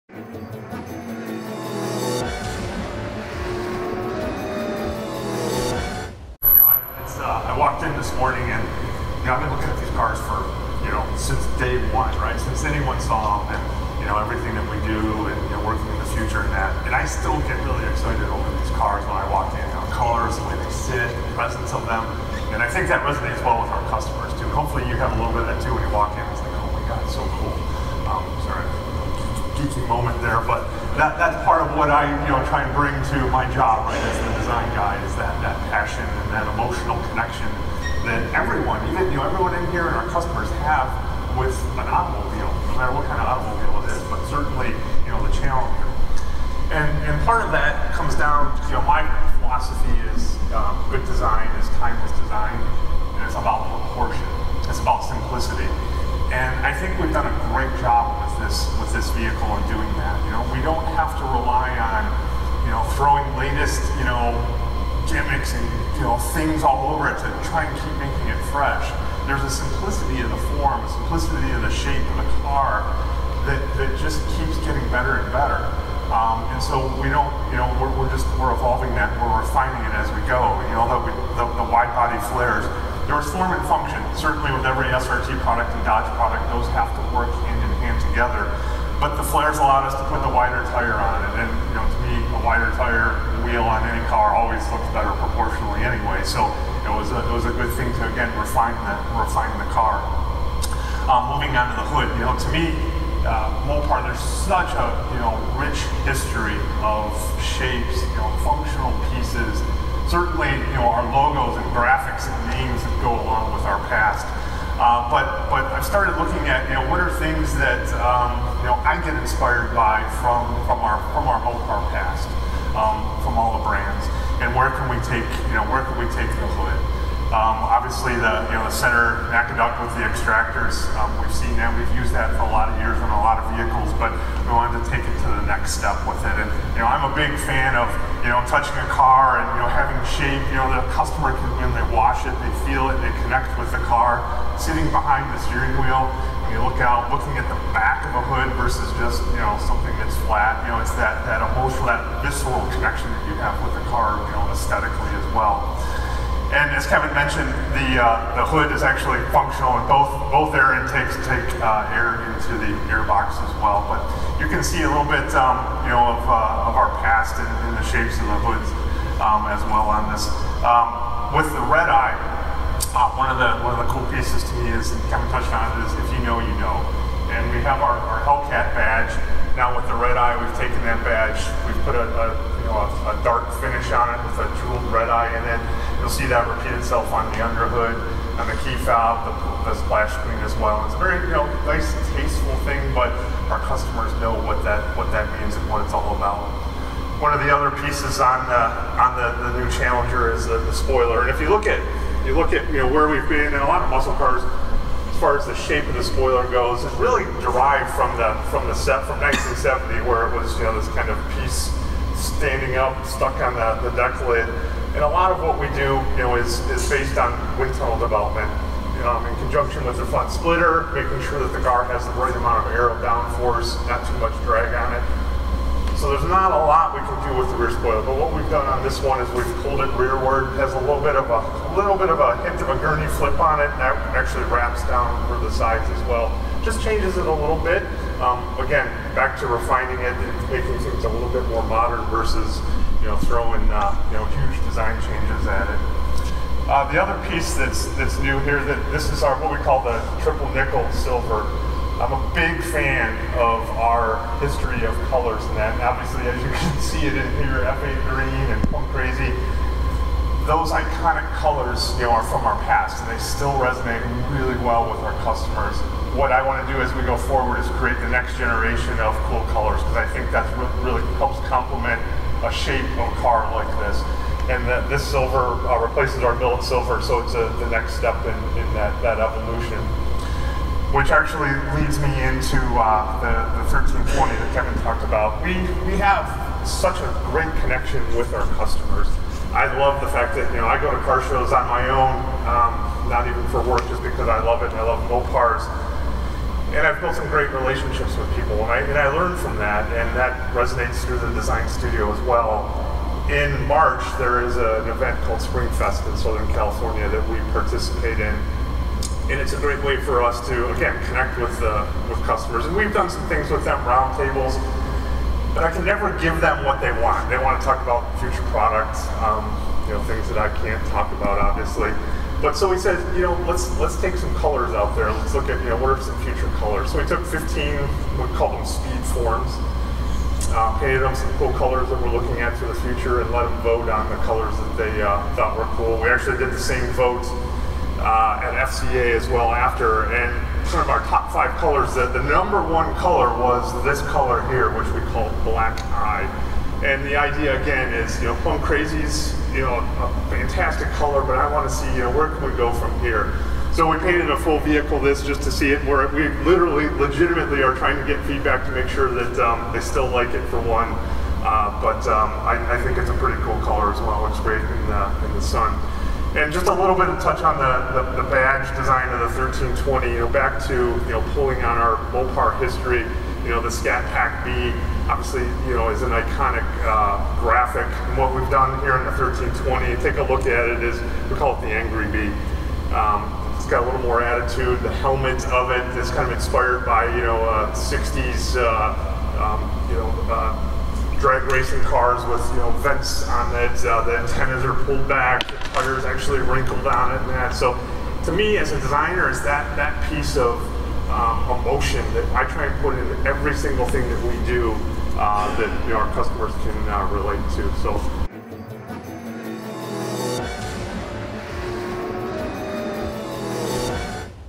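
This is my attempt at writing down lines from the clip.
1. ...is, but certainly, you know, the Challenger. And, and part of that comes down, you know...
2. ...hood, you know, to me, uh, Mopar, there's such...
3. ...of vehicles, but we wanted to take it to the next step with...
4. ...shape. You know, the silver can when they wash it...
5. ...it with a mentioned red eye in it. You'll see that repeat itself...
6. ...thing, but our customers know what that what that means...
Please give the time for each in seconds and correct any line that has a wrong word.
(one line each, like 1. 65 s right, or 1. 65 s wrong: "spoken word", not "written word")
1. 43 s right
2. 101 s right
3. 133 s right
4. 140 s wrong: "customer", not "silver"
5. 184 s wrong: "jeweled", not "mentioned"
6. 192 s right.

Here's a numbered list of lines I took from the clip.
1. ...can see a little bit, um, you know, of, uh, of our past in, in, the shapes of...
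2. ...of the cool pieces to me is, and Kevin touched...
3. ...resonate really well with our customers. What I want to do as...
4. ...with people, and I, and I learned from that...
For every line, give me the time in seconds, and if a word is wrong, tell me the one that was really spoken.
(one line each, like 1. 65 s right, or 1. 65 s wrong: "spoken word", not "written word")
1. 164 s right
2. 173 s right
3. 263 s right
4. 298 s right.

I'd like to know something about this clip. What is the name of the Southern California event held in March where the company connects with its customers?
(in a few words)
Spring Fest.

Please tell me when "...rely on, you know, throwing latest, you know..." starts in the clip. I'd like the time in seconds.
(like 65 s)
61 s.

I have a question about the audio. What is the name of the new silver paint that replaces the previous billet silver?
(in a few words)
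Triple nickel silver.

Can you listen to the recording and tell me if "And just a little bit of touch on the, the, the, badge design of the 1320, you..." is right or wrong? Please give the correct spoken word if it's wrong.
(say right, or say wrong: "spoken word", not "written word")
right.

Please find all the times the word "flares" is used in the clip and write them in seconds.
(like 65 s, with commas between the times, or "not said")
82 s, 89 s.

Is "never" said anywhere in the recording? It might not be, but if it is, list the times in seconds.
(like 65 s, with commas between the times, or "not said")
315 s.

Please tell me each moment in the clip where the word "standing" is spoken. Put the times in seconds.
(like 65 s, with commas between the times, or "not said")
212 s.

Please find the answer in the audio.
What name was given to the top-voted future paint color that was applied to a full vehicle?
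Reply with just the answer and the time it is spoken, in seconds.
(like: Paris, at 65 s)
Black eye, at 345 s.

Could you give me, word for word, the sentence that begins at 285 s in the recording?
We, we have such a great connection with our customers.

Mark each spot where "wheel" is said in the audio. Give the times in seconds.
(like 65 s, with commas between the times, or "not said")
93 s, 145 s.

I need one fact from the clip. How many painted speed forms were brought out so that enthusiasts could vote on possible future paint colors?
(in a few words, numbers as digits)
15.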